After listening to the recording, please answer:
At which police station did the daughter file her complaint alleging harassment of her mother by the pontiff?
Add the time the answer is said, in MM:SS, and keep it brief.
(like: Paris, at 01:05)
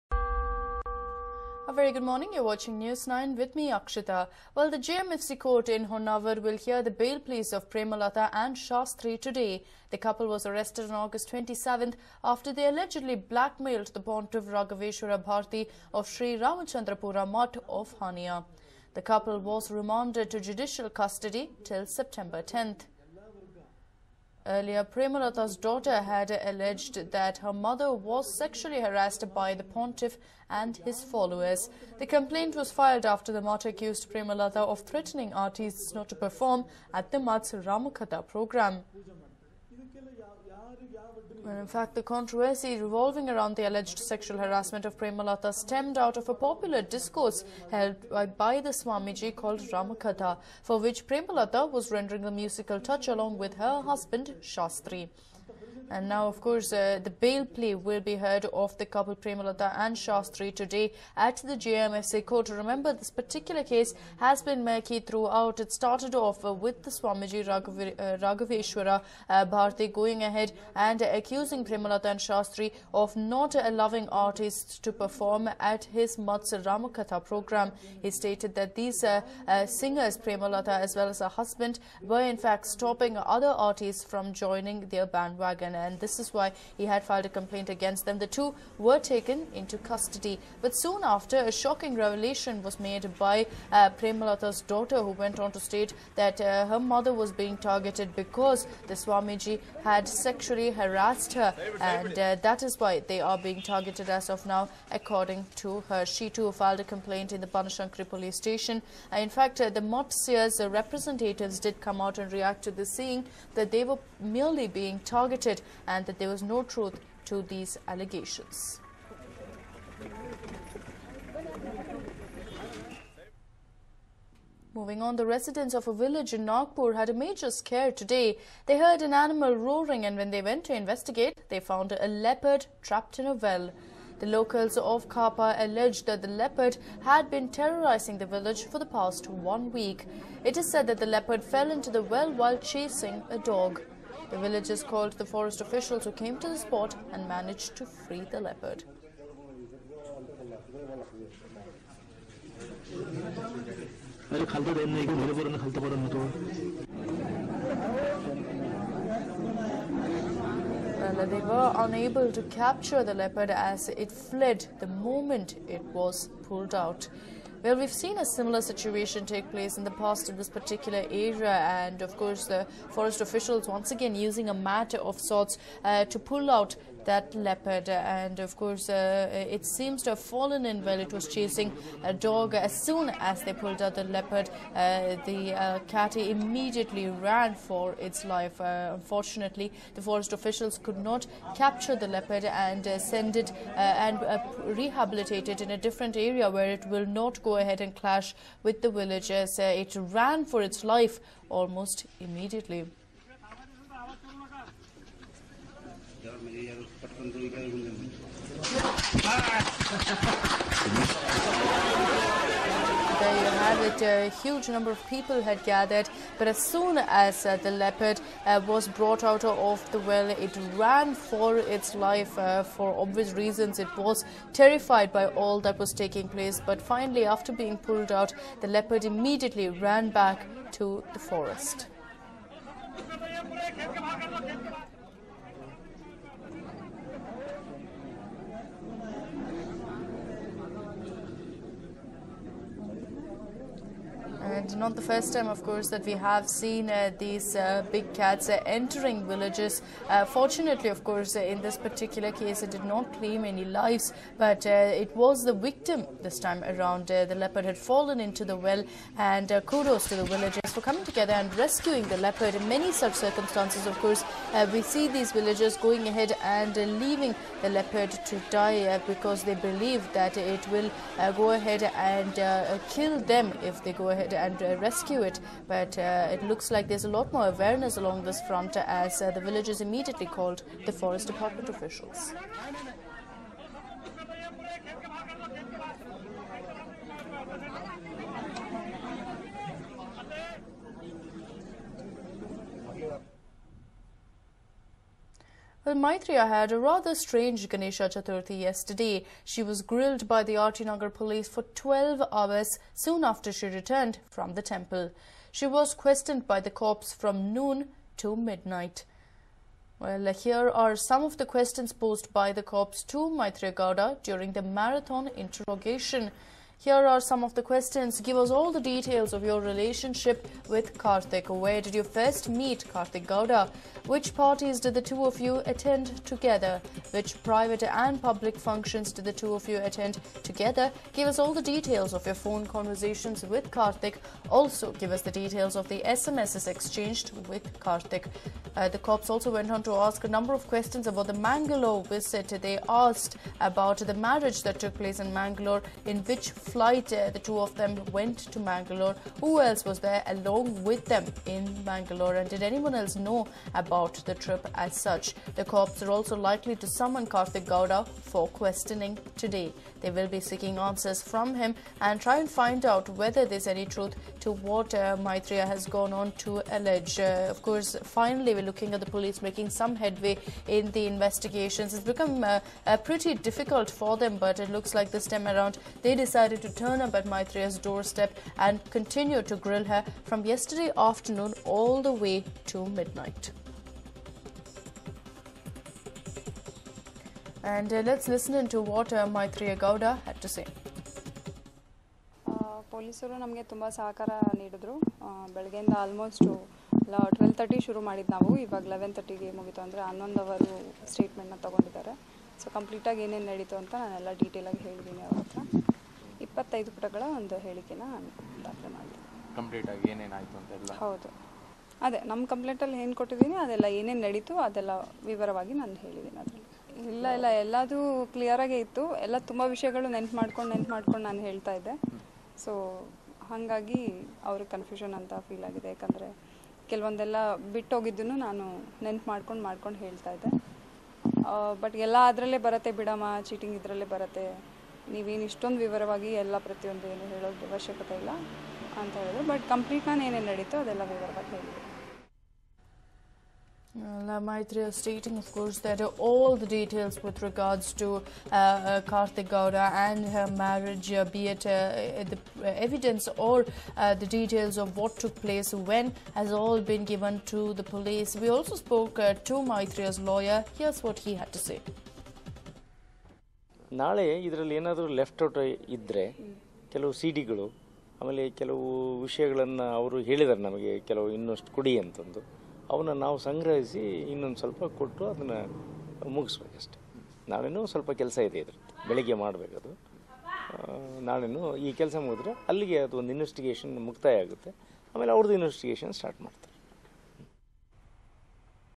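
Banashankari police station, at 01:47.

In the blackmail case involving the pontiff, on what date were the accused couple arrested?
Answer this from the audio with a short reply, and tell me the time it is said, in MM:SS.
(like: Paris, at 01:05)
August 27, at 00:10.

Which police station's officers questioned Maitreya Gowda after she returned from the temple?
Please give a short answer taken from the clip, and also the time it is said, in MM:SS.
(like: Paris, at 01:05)
RT Nagar, at 05:00.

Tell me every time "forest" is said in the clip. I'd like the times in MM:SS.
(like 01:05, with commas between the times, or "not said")
02:25, 02:52, 03:10, 03:51, 04:40.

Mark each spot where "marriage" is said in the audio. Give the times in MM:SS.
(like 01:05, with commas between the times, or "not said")
05:44, 07:30.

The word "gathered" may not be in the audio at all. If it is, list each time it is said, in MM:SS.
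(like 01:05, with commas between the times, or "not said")
03:35.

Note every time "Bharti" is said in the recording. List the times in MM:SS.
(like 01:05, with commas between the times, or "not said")
00:15, 01:09.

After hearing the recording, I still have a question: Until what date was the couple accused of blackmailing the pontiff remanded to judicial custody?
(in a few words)
September 10.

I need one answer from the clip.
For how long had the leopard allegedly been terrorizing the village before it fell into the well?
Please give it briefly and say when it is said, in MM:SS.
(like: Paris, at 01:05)
One week, at 02:19.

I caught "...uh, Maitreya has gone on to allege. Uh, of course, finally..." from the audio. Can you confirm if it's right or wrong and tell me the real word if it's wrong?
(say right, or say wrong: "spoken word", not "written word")
right.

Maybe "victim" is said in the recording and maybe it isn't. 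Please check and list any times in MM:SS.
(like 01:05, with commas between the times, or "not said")
04:15.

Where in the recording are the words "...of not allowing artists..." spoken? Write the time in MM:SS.
01:12.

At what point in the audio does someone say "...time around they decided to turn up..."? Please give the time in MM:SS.
06:15.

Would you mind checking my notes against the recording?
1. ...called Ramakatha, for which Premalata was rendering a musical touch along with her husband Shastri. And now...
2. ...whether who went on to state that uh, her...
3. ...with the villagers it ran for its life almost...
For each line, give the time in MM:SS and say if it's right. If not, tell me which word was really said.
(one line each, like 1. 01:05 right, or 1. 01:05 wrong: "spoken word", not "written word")
1. 00:49 right
2. 01:34 wrong: "daughter", not "whether"
3. 03:18 right.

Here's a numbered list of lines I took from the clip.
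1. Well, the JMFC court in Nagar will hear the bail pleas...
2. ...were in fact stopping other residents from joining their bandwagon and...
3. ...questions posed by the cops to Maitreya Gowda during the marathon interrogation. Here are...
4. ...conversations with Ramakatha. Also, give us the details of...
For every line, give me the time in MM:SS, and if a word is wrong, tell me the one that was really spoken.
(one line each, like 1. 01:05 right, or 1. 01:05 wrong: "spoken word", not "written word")
1. 00:04 wrong: "Honavar", not "Nagar"
2. 01:22 wrong: "artists", not "residents"
3. 05:11 right
4. 05:32 wrong: "Karthik", not "Ramakatha".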